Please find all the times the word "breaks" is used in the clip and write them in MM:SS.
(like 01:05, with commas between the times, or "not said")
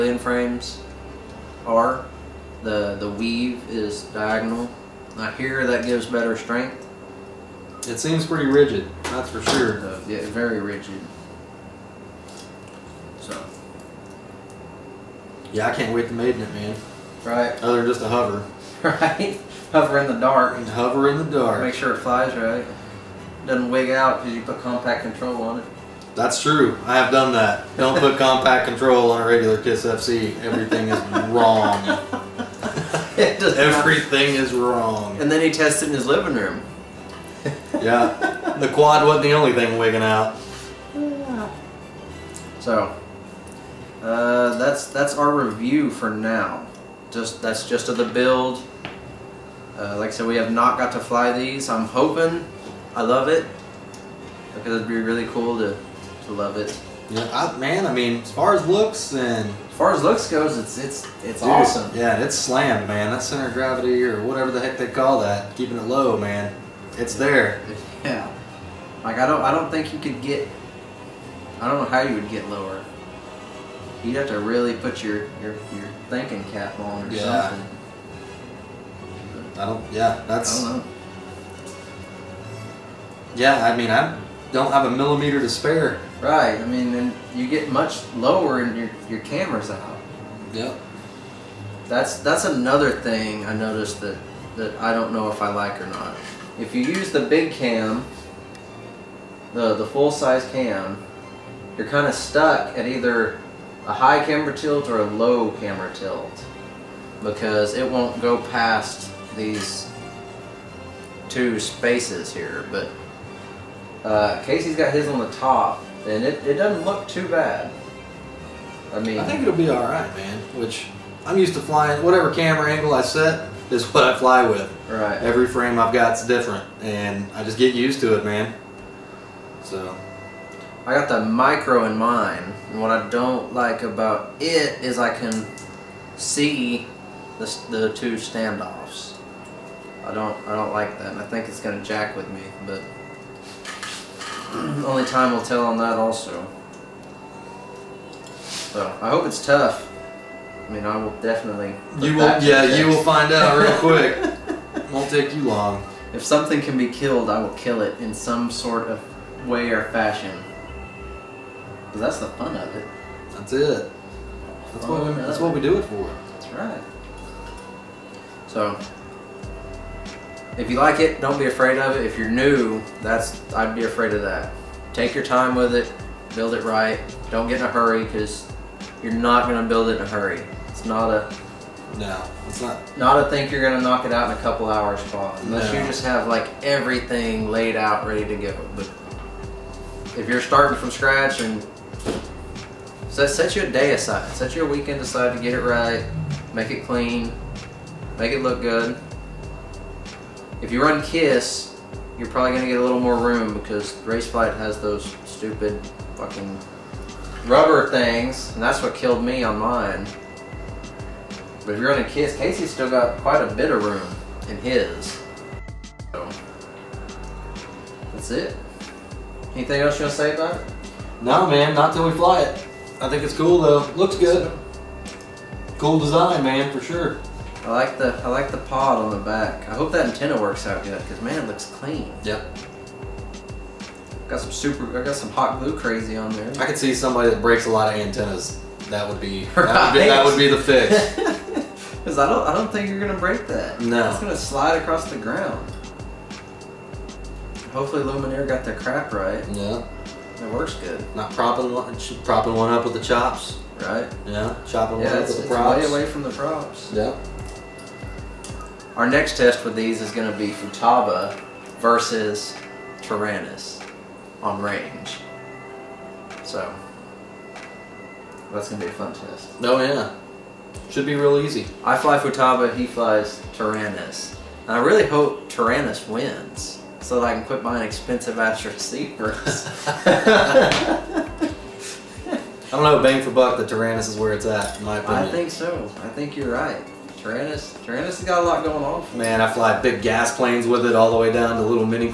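03:57, 04:03.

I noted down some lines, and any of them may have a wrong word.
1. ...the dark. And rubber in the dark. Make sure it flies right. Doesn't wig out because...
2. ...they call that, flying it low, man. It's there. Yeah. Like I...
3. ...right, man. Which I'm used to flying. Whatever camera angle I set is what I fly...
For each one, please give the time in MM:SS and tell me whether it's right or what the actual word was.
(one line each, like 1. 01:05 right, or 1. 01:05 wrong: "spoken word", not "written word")
1. 00:20 wrong: "hover", not "rubber"
2. 01:04 wrong: "keeping", not "flying"
3. 01:59 right.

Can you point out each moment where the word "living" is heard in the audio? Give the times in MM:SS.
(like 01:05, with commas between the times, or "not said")
00:36.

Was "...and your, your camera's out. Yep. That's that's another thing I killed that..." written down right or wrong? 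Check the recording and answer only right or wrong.
wrong.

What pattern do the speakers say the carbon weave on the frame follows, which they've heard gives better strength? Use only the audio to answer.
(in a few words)
Diagonal.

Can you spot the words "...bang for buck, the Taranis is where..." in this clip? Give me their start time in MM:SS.
04:43.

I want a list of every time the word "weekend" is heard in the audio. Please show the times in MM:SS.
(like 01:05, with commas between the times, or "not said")
03:14.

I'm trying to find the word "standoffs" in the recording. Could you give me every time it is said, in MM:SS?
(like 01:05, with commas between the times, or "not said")
02:18.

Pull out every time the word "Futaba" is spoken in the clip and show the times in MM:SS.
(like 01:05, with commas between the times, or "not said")
04:20, 04:32.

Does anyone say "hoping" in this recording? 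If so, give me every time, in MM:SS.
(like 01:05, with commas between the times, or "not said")
00:51.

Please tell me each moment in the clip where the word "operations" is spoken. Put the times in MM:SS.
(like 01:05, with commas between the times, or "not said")
not said.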